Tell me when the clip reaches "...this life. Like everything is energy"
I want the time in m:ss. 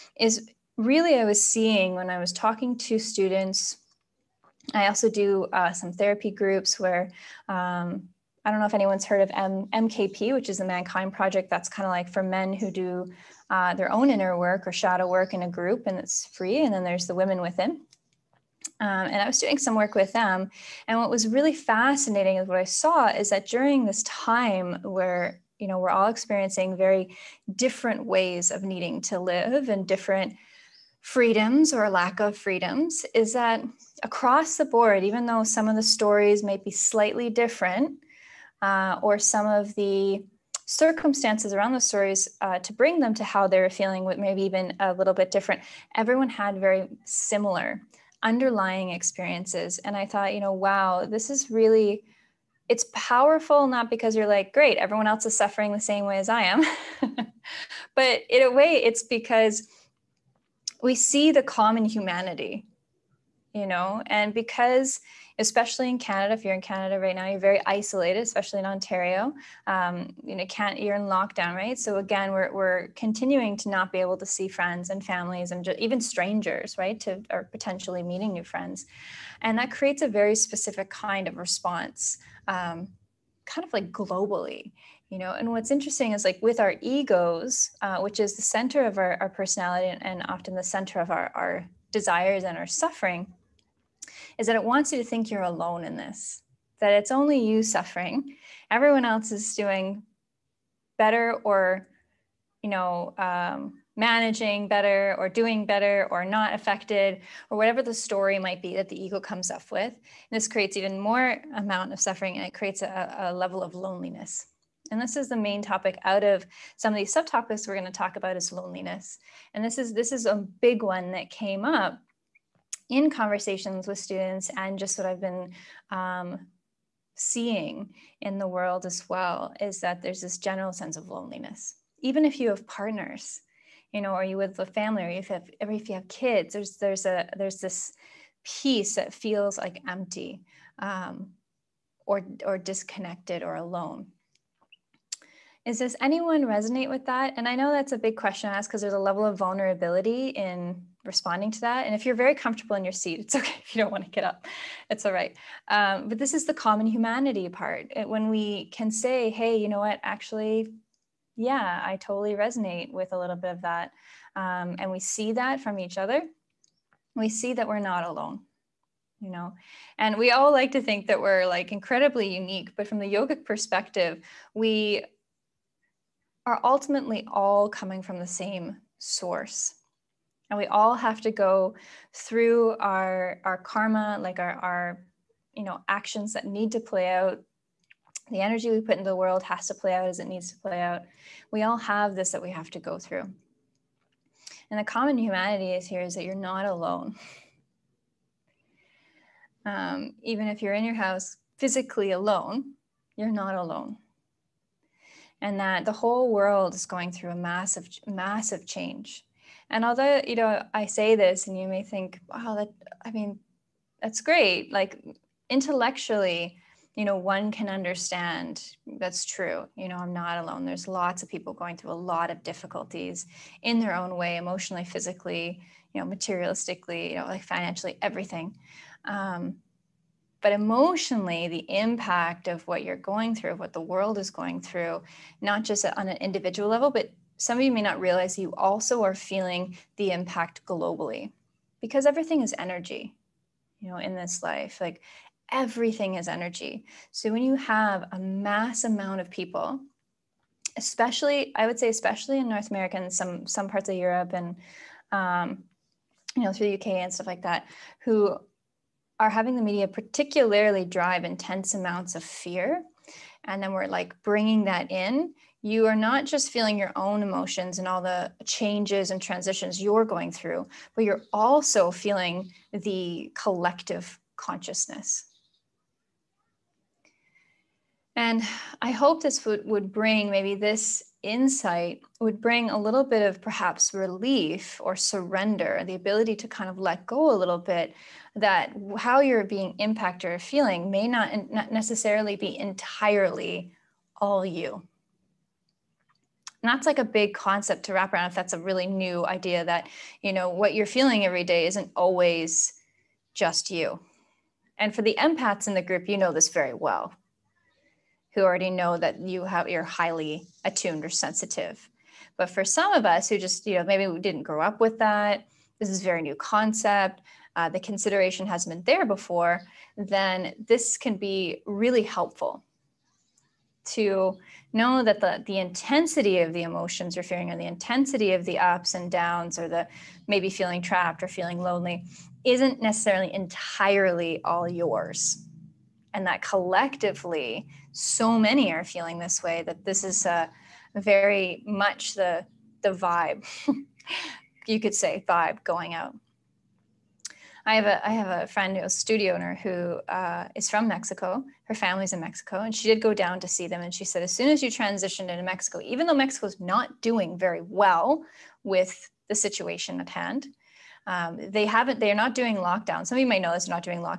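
4:04.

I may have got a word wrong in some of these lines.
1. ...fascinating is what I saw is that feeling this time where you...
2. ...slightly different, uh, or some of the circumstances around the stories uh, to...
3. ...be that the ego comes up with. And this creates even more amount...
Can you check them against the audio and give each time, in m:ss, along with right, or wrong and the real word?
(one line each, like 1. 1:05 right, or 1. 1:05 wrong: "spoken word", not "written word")
1. 0:21 wrong: "during", not "feeling"
2. 0:36 right
3. 1:48 right.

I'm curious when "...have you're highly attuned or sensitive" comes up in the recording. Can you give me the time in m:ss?
5:09.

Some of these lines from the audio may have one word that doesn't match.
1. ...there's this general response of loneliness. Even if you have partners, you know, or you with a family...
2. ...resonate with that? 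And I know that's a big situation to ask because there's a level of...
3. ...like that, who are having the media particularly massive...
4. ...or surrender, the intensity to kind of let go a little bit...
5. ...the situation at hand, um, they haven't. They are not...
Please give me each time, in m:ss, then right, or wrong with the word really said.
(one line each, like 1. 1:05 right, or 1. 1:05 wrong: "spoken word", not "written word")
1. 2:10 wrong: "sense", not "response"
2. 2:26 wrong: "question", not "situation"
3. 4:17 wrong: "drive", not "massive"
4. 4:44 wrong: "ability", not "intensity"
5. 5:59 right.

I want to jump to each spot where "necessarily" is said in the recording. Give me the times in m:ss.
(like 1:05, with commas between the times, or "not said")
4:51, 5:32.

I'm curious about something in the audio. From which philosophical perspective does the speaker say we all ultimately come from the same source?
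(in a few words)
Yogic.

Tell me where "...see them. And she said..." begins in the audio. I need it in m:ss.
5:53.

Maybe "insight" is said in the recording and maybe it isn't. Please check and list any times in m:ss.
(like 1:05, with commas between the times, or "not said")
4:41.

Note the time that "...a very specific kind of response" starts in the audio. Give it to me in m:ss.
1:20.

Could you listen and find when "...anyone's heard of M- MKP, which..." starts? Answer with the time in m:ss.
0:08.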